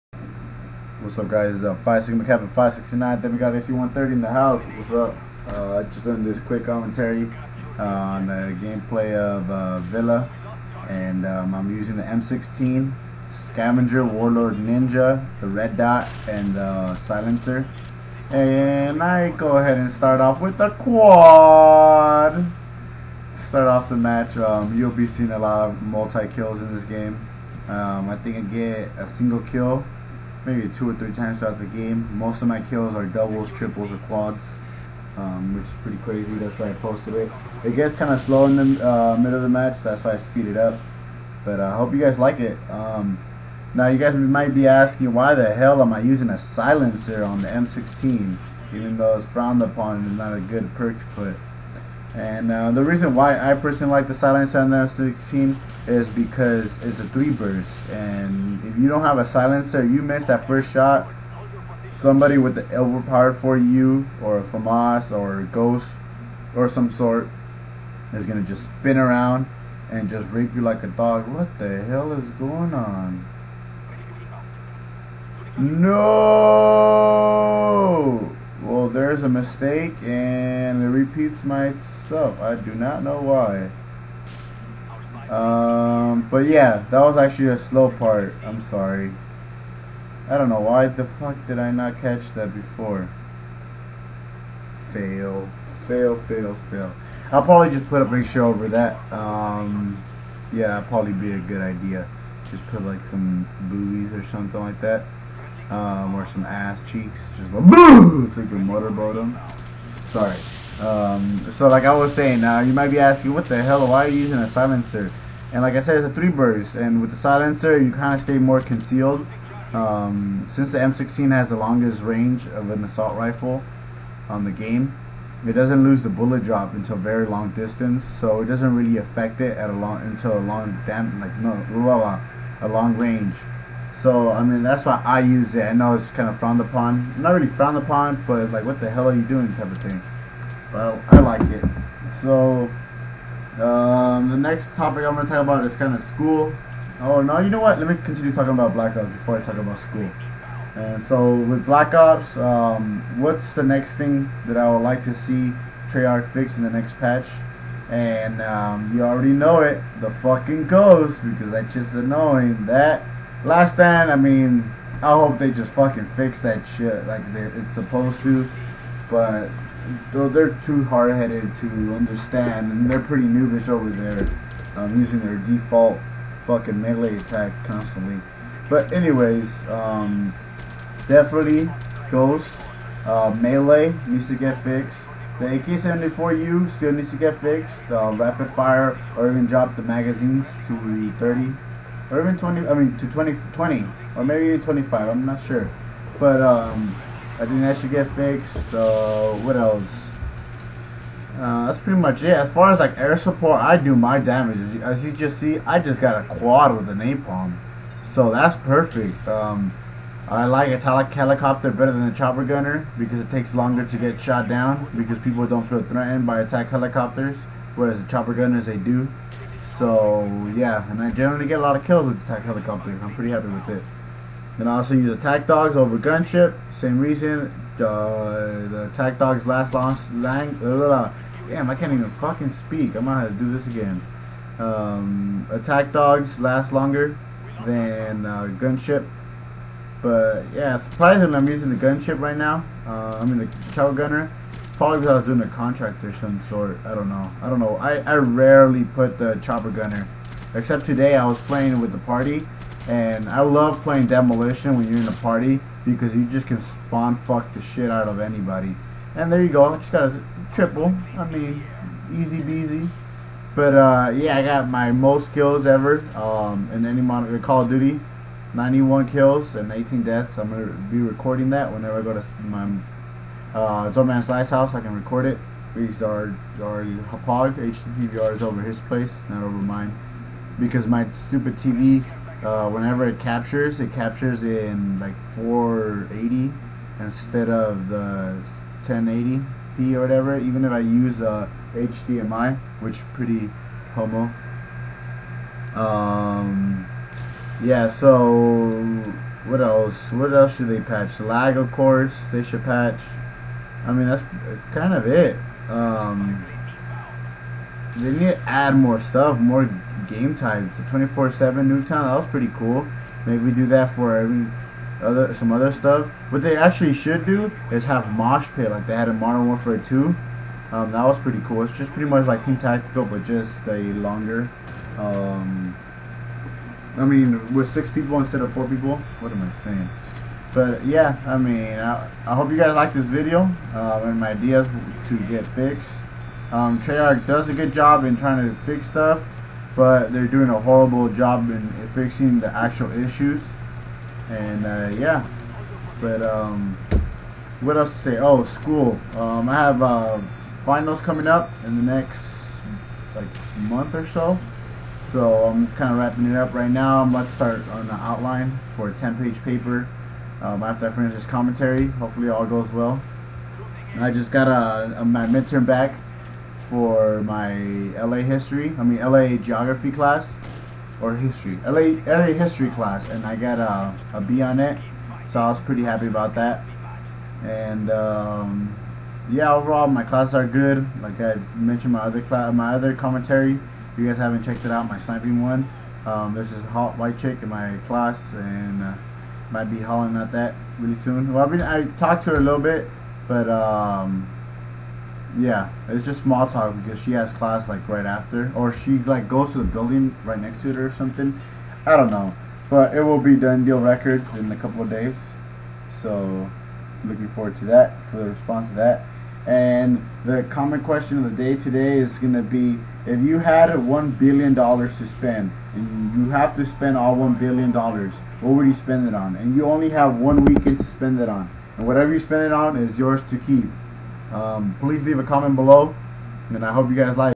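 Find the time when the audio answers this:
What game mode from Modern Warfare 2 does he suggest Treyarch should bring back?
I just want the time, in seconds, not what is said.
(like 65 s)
318 s.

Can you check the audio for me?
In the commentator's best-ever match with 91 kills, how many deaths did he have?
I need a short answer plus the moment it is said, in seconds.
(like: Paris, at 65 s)
18, at 269 s.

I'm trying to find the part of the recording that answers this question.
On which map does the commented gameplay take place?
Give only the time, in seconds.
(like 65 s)
9 s.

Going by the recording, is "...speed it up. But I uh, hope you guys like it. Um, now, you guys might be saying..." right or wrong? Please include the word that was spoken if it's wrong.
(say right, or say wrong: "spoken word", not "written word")
wrong: "asking", not "saying".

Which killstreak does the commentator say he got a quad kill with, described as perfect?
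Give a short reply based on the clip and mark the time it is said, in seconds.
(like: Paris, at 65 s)
napalm, at 206 s.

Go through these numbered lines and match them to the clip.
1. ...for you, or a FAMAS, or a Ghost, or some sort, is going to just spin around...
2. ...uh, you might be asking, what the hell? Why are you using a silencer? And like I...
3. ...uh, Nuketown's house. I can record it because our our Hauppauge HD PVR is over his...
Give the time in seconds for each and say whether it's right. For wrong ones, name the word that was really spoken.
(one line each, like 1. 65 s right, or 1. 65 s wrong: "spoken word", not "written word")
1. 63 s right
2. 112 s right
3. 273 s wrong: "Zomansly", not "Nuketown".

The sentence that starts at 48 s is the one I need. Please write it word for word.
Even though it's frowned upon and not a good perk to put.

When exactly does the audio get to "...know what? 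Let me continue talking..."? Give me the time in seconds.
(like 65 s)
147 s.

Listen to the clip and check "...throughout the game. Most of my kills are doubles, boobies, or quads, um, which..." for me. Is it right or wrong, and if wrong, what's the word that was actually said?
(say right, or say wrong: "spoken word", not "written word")
wrong: "triples", not "boobies".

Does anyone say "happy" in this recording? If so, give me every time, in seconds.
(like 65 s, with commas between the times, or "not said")
223 s, 375 s.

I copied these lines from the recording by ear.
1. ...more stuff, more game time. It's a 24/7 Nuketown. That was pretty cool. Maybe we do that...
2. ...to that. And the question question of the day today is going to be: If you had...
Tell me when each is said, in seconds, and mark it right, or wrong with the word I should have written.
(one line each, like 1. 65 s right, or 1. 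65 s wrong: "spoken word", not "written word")
1. 308 s right
2. 408 s wrong: "common", not "question".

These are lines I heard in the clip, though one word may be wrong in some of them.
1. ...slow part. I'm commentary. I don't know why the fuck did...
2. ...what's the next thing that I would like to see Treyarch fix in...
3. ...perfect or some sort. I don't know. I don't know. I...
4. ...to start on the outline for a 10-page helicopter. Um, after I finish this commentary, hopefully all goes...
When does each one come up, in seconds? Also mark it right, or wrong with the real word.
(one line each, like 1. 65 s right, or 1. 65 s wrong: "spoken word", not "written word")
1. 87 s wrong: "sorry", not "commentary"
2. 153 s right
3. 245 s wrong: "contract", not "perfect"
4. 357 s wrong: "paper", not "helicopter".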